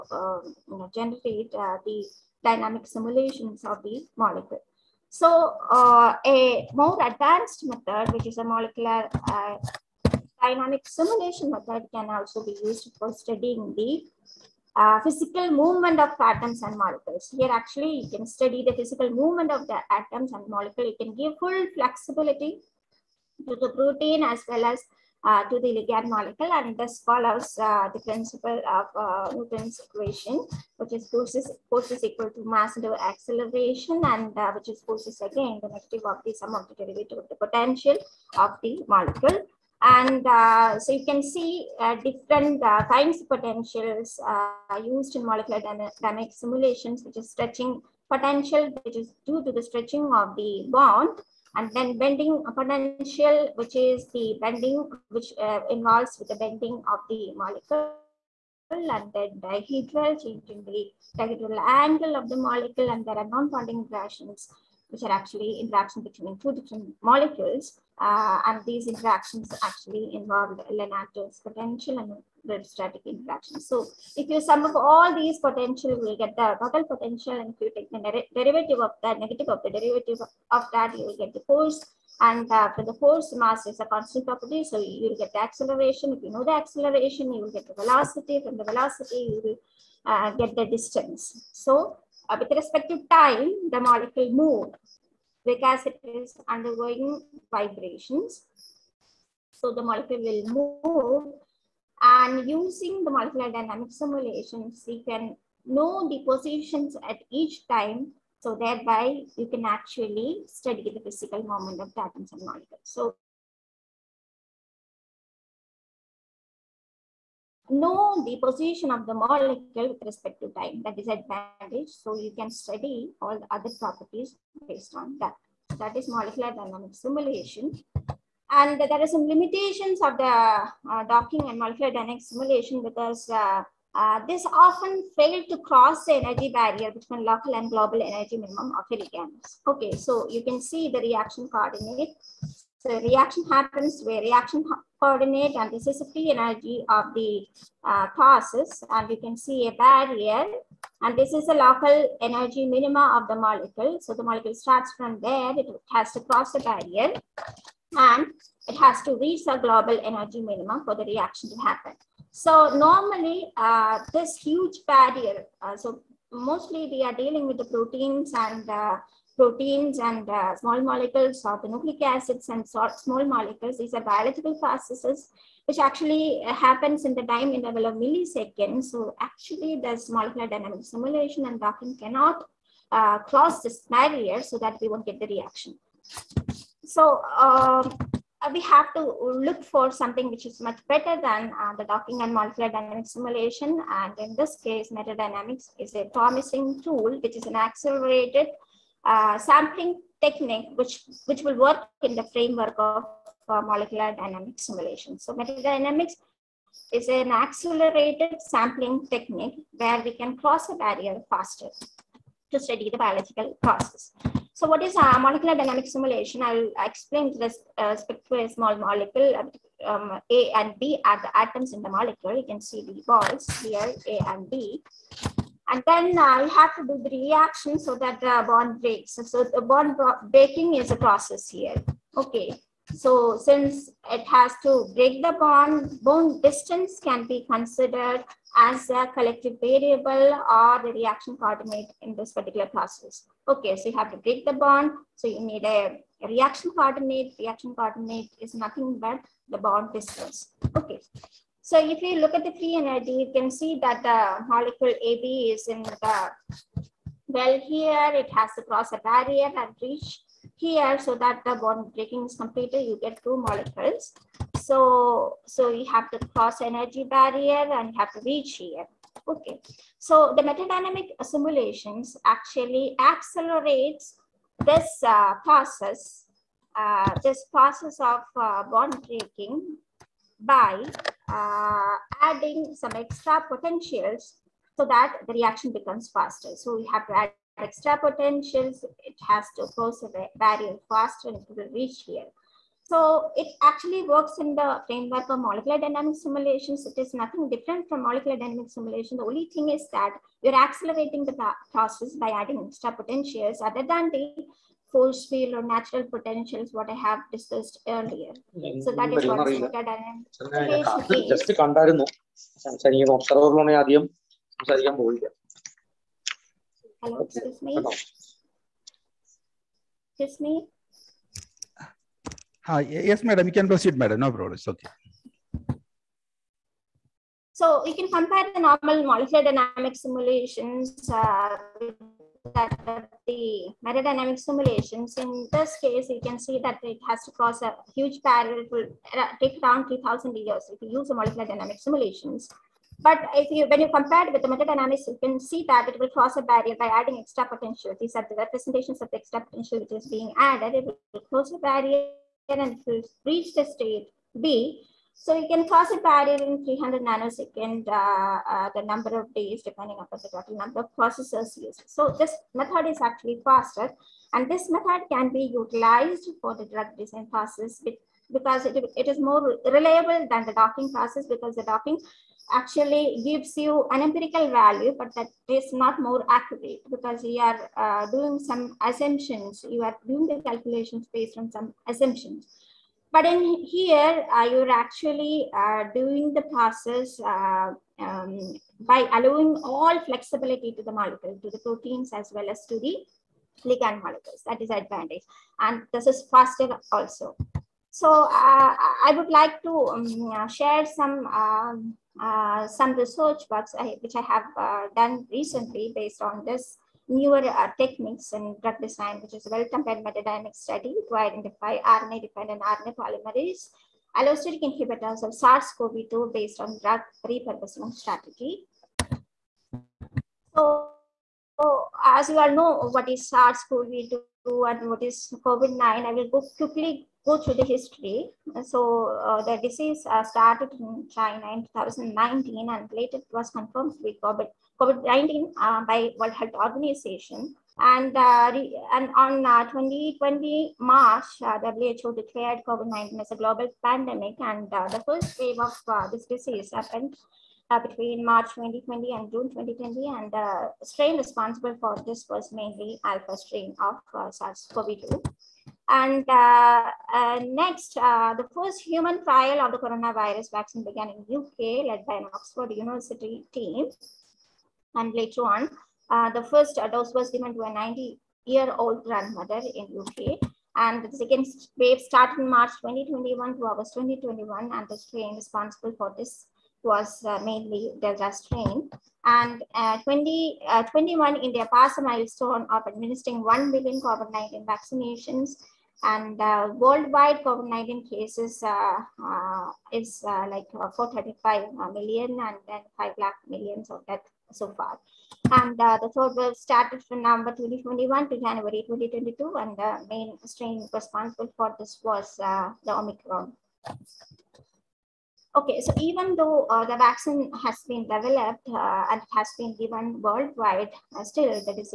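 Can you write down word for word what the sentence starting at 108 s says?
So thereby you can actually study the physical moment of the atoms and molecules.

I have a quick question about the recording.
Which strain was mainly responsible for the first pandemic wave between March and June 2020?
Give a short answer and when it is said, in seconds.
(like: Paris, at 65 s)
alpha, at 453 s.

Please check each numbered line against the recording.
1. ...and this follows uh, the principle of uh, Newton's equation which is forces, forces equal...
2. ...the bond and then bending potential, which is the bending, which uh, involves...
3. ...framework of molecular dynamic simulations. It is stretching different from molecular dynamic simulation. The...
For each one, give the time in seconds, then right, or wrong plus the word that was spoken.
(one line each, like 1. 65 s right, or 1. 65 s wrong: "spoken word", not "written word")
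1. 26 s right
2. 50 s right
3. 294 s wrong: "nothing", not "stretching".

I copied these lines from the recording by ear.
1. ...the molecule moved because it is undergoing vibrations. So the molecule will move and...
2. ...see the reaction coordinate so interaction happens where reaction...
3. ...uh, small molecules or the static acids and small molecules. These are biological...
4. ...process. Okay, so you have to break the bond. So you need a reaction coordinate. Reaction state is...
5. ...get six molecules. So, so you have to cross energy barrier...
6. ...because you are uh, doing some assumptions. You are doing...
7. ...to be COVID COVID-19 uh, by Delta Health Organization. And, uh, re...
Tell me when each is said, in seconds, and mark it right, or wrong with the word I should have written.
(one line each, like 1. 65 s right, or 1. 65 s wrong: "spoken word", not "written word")
1. 93 s right
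2. 140 s wrong: "reaction", not "interaction"
3. 170 s wrong: "nucleic", not "static"
4. 242 s wrong: "coordinate", not "state"
5. 263 s wrong: "two", not "six"
6. 376 s right
7. 433 s wrong: "World", not "Delta".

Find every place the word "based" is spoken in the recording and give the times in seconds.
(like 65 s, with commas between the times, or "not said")
124 s, 381 s, 405 s, 416 s.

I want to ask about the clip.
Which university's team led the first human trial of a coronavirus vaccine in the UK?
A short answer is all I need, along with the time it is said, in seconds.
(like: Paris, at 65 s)
Oxford University, at 462 s.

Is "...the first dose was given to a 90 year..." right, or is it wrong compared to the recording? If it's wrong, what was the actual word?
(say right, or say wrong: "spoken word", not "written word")
right.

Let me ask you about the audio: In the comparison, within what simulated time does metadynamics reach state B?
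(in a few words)
300 nanoseconds.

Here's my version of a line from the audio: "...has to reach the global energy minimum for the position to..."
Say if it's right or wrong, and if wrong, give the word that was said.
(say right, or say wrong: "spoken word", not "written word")
wrong: "reaction", not "position".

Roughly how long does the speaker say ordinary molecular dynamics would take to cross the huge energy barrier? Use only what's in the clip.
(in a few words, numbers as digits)
3,000 years.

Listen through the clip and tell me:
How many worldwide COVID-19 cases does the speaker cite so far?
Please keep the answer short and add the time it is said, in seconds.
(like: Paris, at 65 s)
435 million, at 490 s.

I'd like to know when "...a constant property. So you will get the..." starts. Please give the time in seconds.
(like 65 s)
83 s.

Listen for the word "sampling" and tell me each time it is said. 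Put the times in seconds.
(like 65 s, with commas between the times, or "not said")
199 s, 208 s.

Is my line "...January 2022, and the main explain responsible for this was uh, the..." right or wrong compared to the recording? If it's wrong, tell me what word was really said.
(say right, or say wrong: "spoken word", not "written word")
wrong: "strain", not "explain".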